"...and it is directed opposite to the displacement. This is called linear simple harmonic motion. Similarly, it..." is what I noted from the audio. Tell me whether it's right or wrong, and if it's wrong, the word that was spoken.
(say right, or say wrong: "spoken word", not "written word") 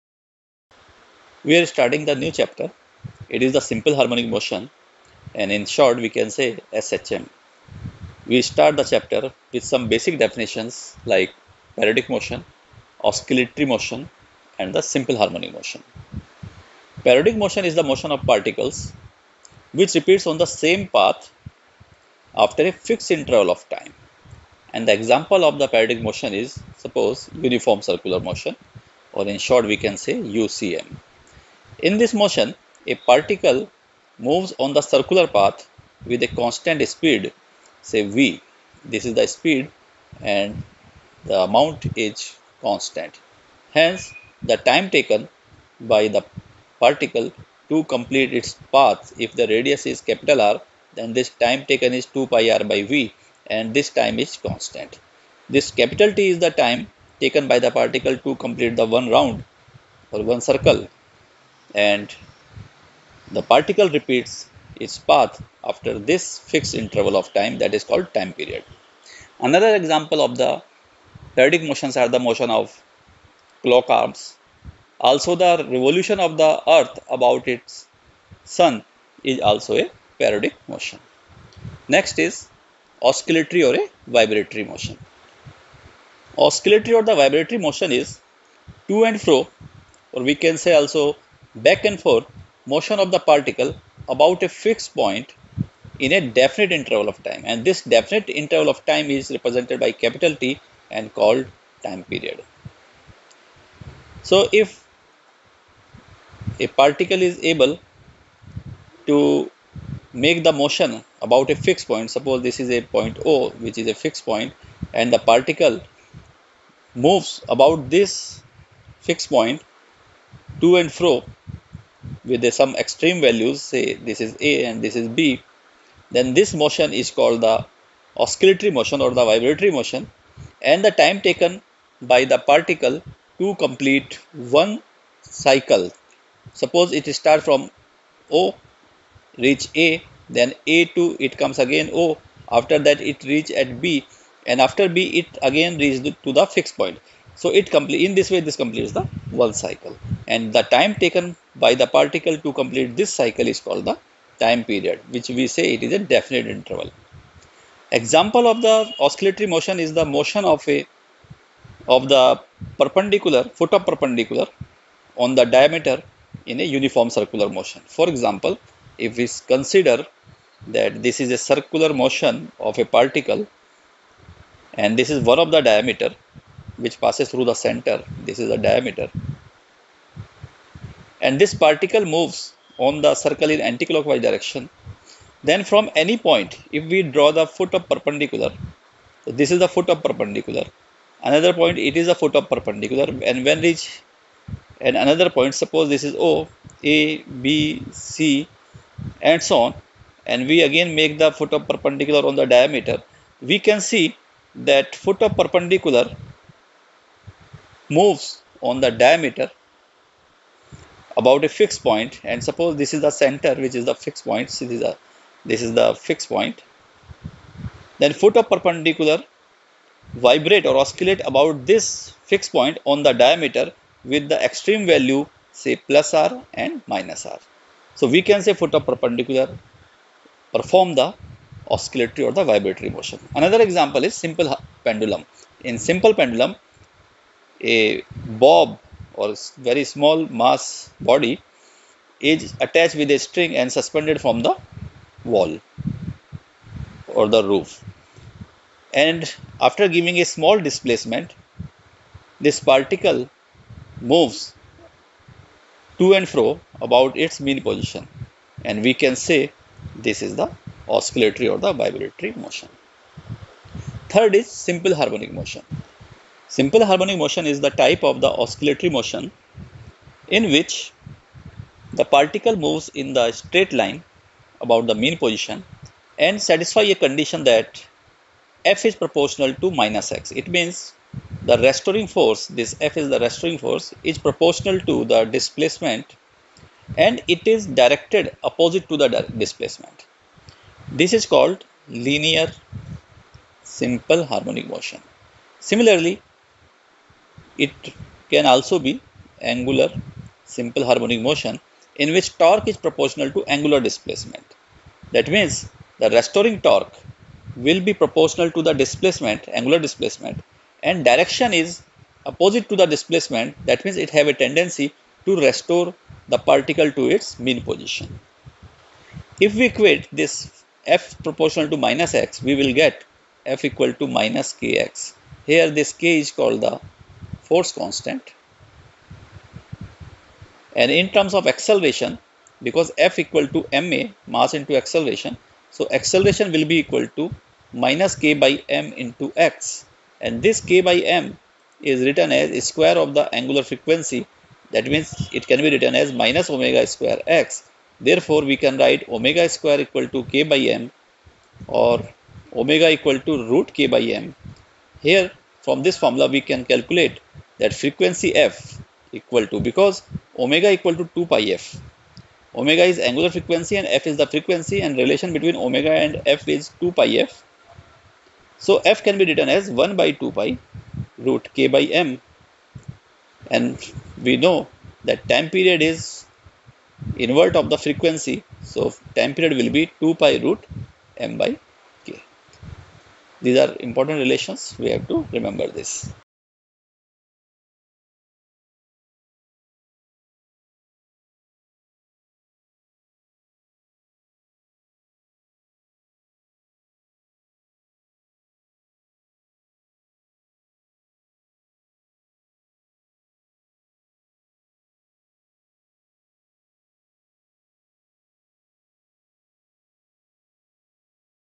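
right.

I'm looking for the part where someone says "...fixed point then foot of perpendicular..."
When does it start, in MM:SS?
03:36.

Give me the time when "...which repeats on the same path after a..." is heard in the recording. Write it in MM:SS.
00:19.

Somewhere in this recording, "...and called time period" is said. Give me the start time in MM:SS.
01:40.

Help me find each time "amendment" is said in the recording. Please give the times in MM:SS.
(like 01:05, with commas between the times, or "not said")
not said.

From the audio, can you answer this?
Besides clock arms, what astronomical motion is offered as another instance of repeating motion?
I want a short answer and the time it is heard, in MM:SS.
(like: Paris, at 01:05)
Revolution of the earth, at 01:15.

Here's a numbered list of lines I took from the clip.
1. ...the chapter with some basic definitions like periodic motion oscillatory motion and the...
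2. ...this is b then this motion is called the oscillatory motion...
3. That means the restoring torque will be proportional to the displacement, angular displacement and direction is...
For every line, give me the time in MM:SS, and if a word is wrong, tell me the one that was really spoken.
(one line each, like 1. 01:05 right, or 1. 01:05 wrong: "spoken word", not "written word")
1. 00:08 right
2. 02:04 right
3. 05:05 right.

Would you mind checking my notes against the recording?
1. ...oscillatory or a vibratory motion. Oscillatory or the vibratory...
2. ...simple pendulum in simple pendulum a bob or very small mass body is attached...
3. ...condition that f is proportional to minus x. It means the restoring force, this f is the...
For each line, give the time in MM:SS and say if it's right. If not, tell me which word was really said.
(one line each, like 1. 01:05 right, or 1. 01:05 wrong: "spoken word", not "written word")
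1. 01:23 right
2. 03:54 right
3. 04:37 right.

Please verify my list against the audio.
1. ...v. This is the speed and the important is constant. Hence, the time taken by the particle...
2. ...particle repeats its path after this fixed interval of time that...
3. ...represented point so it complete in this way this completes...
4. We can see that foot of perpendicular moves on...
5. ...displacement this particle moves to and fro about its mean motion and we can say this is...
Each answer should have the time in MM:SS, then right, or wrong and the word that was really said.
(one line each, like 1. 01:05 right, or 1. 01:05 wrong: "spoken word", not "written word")
1. 00:38 wrong: "amount", not "important"
2. 01:03 right
3. 02:26 wrong: "fixed", not "represented"
4. 03:23 right
5. 04:10 wrong: "position", not "motion".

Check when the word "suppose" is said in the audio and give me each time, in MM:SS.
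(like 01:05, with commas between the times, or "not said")
00:26, 01:52, 02:16, 03:15, 03:32.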